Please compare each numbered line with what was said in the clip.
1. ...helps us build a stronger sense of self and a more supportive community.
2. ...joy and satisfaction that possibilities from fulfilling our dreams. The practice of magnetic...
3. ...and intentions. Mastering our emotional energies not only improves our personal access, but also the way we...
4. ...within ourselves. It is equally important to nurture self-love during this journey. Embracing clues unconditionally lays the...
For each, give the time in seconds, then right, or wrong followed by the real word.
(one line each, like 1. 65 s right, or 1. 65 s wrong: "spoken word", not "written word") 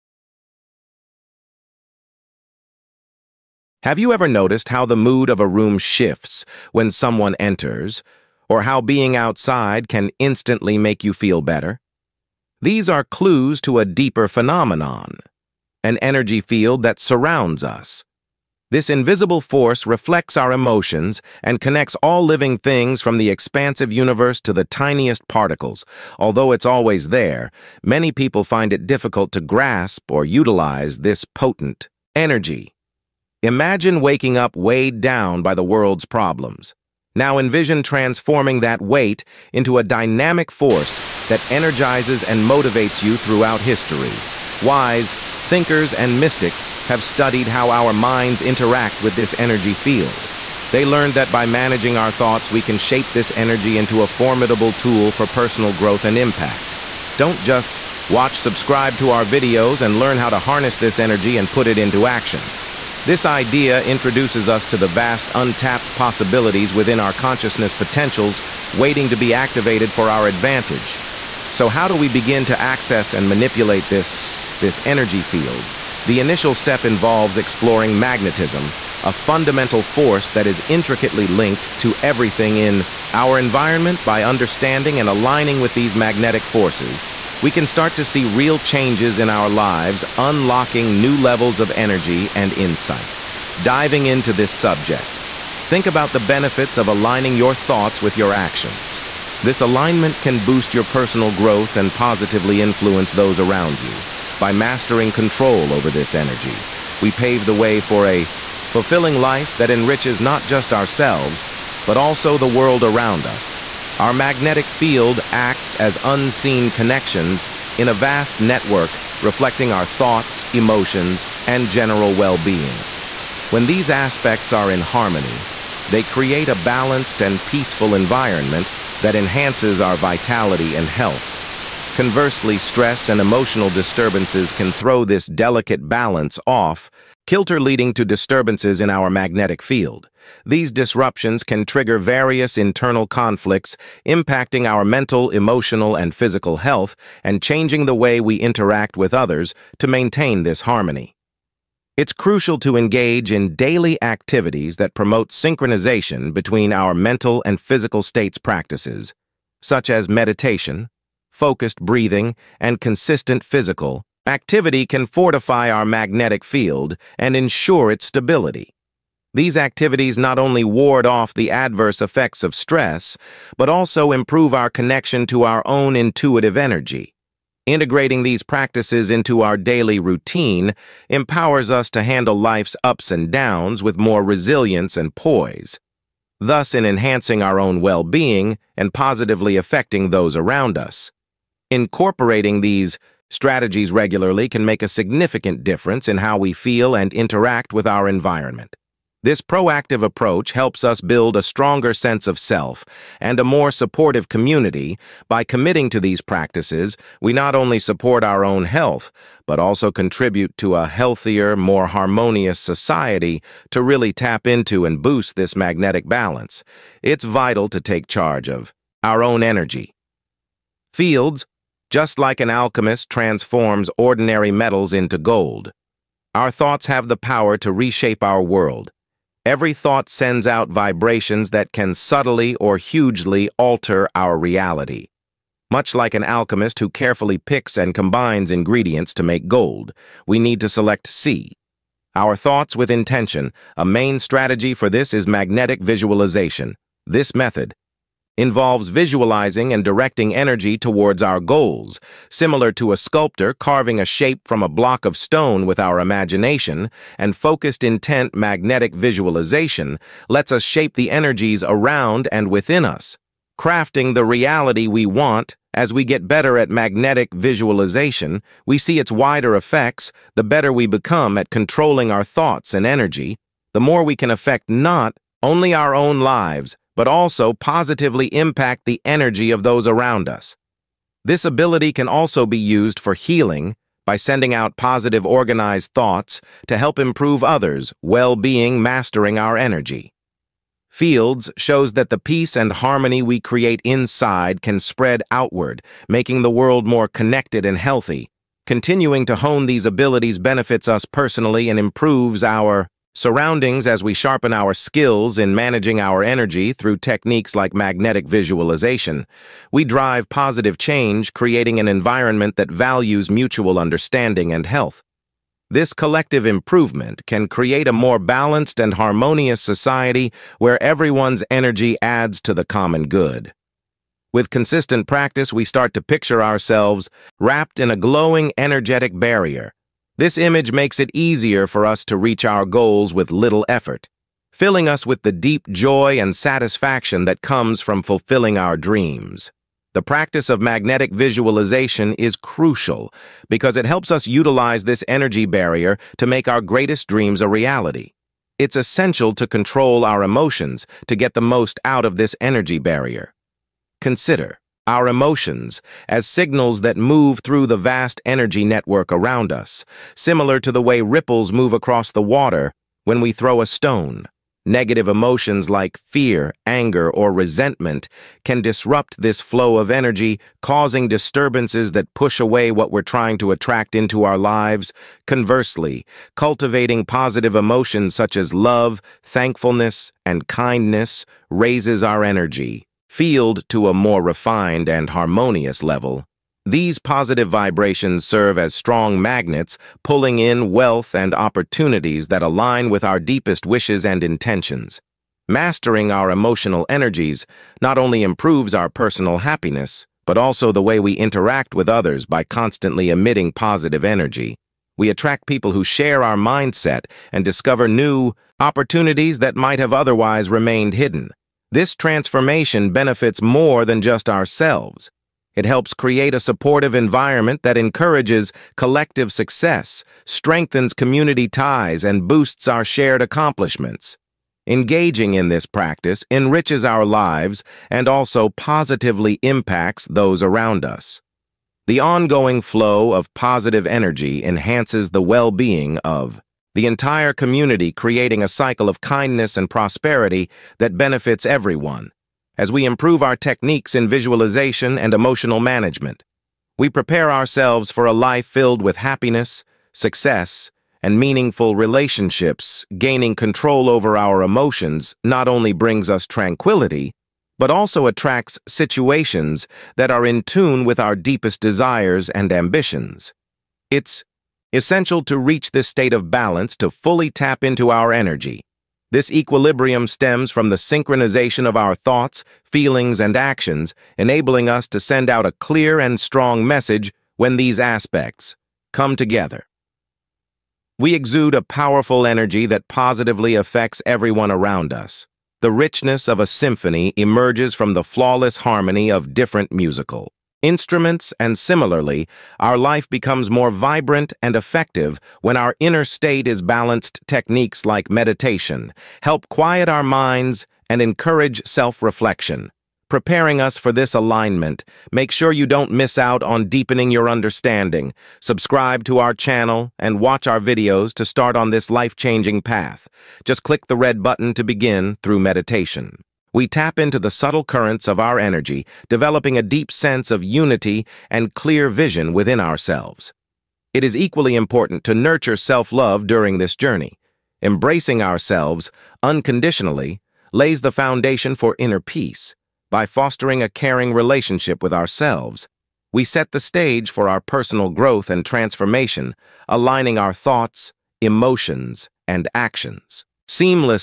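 1. 200 s right
2. 335 s wrong: "comes", not "possibilities"
3. 394 s wrong: "happiness", not "access"
4. 522 s wrong: "ourselves", not "clues".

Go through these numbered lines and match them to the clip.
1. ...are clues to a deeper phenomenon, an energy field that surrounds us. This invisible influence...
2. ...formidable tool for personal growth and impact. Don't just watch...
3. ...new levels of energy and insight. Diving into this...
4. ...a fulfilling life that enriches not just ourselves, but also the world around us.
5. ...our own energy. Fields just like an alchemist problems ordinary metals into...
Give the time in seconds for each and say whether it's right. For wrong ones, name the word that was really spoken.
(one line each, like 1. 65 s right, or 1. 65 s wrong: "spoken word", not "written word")
1. 12 s wrong: "force", not "influence"
2. 54 s right
3. 91 s right
4. 108 s right
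5. 219 s wrong: "transforms", not "problems".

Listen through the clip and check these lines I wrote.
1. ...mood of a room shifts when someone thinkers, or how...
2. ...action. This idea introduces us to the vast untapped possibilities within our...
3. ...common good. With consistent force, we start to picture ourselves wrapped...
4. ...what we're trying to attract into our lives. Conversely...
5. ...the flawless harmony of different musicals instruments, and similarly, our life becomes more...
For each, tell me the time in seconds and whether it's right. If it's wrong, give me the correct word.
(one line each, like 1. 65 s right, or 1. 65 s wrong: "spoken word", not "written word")
1. 4 s wrong: "enters", not "thinkers"
2. 62 s right
3. 322 s wrong: "practice", not "force"
4. 372 s right
5. 487 s right.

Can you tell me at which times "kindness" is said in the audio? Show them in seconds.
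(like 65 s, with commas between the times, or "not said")
380 s, 439 s.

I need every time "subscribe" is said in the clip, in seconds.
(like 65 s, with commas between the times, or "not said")
58 s, 508 s.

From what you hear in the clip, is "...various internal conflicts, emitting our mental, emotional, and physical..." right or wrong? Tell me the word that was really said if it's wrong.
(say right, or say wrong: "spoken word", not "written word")
wrong: "impacting", not "emitting".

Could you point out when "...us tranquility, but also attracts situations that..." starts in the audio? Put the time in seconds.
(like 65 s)
456 s.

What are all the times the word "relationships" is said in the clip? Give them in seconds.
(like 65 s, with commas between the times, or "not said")
451 s, 534 s.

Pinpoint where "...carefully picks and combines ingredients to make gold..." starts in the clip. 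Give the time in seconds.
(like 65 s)
236 s.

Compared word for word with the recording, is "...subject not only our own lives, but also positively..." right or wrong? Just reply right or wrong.
wrong.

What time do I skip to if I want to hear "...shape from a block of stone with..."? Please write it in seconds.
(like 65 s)
254 s.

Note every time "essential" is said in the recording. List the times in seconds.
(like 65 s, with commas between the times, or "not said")
348 s, 464 s.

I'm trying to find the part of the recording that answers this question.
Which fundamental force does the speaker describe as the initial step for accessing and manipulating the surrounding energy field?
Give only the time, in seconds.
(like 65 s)
77 s.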